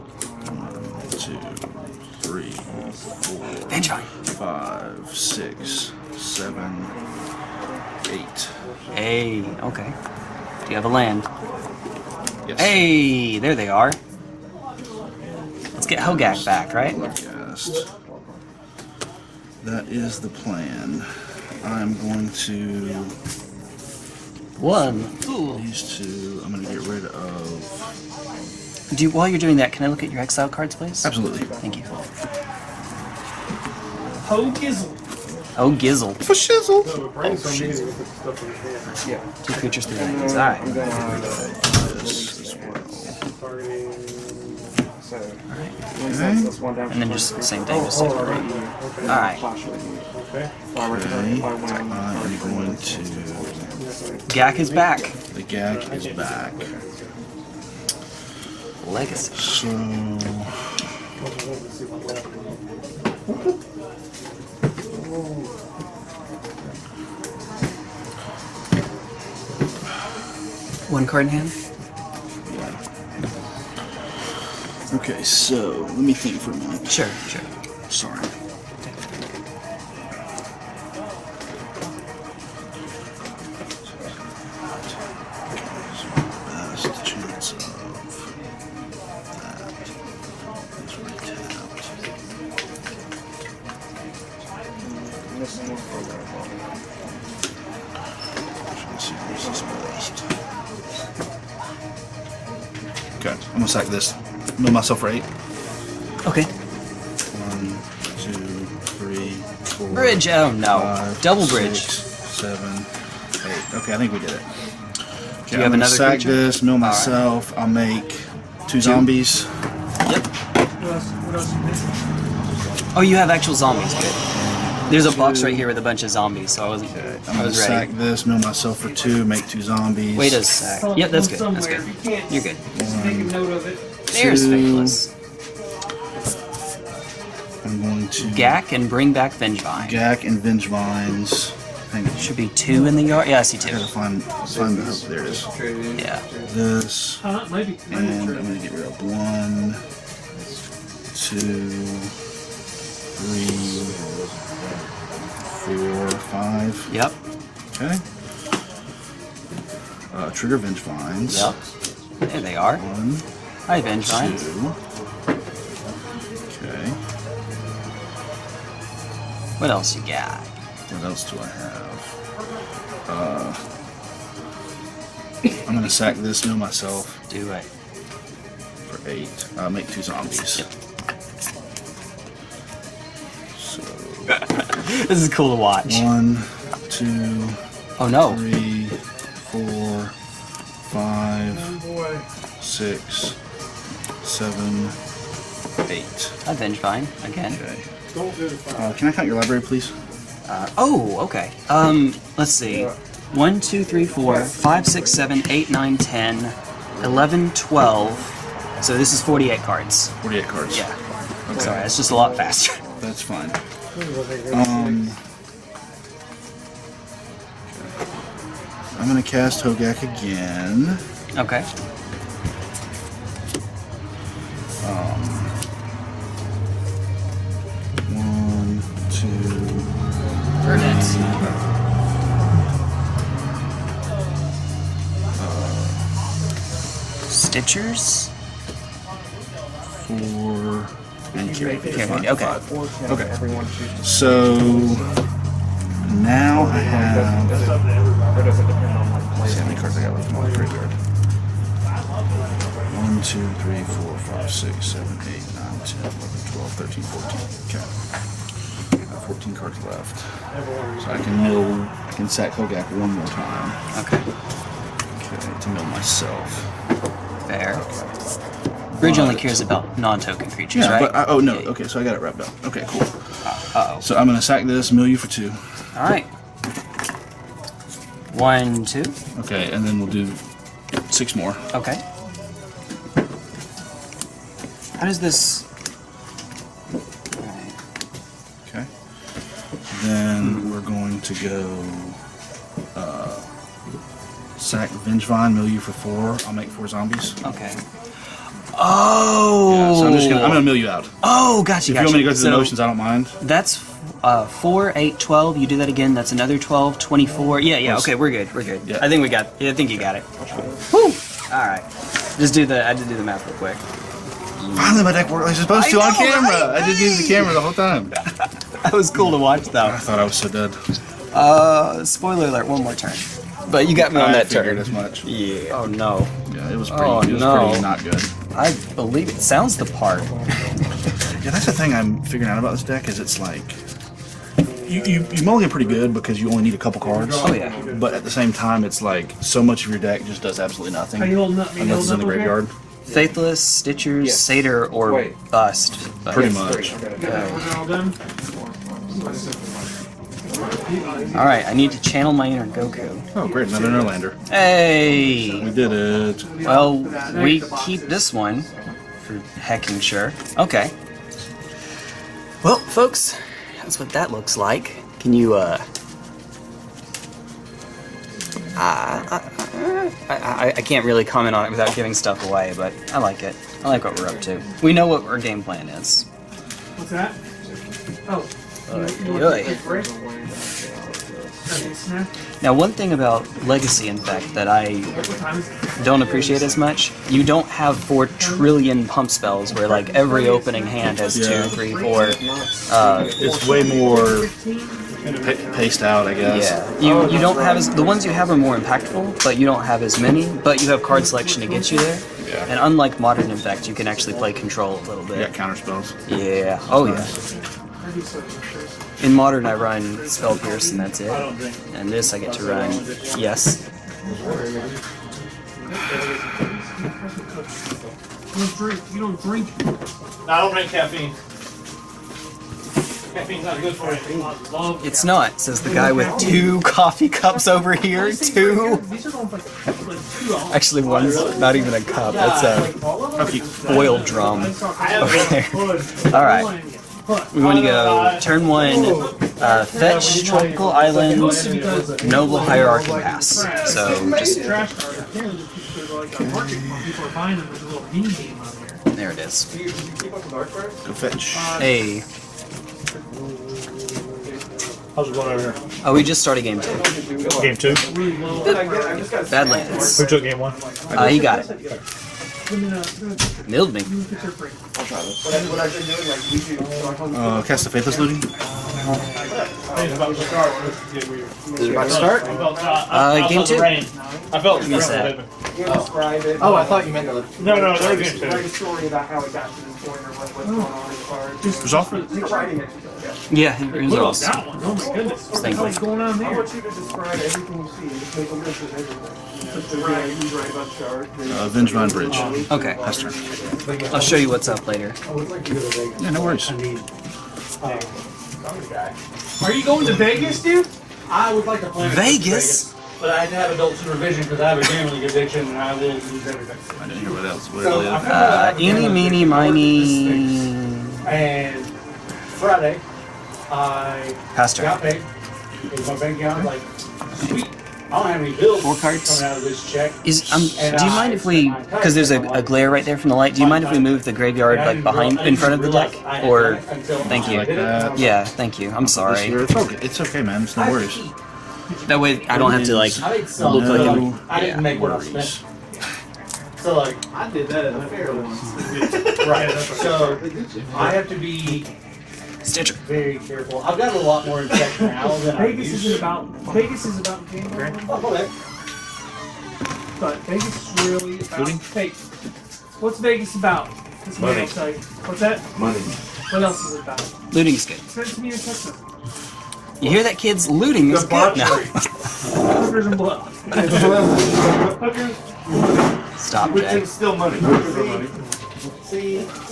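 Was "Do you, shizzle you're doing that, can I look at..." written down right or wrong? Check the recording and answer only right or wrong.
wrong.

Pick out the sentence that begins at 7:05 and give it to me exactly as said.
It's not, says the guy with two coffee cups over here.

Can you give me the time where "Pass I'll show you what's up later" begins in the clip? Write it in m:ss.
8:12.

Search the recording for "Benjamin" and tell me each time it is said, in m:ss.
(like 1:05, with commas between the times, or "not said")
0:03, 2:43.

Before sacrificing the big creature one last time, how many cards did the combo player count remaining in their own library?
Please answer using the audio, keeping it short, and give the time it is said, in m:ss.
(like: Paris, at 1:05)
14, at 4:19.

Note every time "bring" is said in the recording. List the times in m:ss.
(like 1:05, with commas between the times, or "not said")
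2:18.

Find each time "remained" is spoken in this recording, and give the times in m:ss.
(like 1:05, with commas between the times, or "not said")
not said.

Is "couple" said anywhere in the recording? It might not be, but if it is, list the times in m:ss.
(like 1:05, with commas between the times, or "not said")
5:36.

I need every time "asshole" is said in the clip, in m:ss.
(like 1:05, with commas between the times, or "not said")
not said.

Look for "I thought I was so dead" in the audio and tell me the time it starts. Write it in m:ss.
5:19.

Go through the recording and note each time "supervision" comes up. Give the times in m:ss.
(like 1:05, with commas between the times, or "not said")
8:23.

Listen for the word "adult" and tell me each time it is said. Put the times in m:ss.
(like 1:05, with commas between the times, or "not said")
8:23.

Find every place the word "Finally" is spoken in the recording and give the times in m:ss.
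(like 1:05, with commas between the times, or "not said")
5:14.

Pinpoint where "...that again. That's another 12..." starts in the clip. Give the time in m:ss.
5:05.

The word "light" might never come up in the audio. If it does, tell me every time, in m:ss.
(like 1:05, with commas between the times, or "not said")
8:43.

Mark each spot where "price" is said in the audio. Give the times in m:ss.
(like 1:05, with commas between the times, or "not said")
not said.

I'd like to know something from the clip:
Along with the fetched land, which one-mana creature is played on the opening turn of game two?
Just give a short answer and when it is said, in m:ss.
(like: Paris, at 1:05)
Noble Hierarch, at 7:22.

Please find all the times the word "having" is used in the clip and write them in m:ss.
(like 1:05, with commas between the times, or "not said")
not said.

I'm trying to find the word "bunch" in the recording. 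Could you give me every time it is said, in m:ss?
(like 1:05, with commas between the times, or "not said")
2:05.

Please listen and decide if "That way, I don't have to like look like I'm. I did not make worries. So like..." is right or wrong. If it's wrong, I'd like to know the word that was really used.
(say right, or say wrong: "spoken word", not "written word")
right.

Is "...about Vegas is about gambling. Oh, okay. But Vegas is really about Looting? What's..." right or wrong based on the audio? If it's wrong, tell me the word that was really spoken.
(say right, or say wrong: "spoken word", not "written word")
right.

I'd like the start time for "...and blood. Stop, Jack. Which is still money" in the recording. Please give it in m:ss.
9:23.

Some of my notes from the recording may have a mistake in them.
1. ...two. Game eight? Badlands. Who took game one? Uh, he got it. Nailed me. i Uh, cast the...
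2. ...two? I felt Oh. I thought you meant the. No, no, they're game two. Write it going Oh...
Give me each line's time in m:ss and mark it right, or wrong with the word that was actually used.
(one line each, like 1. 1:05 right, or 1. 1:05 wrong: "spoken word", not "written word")
1. 7:36 wrong: "two", not "eight"
2. 7:53 right.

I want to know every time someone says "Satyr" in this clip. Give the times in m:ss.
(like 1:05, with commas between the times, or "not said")
5:44.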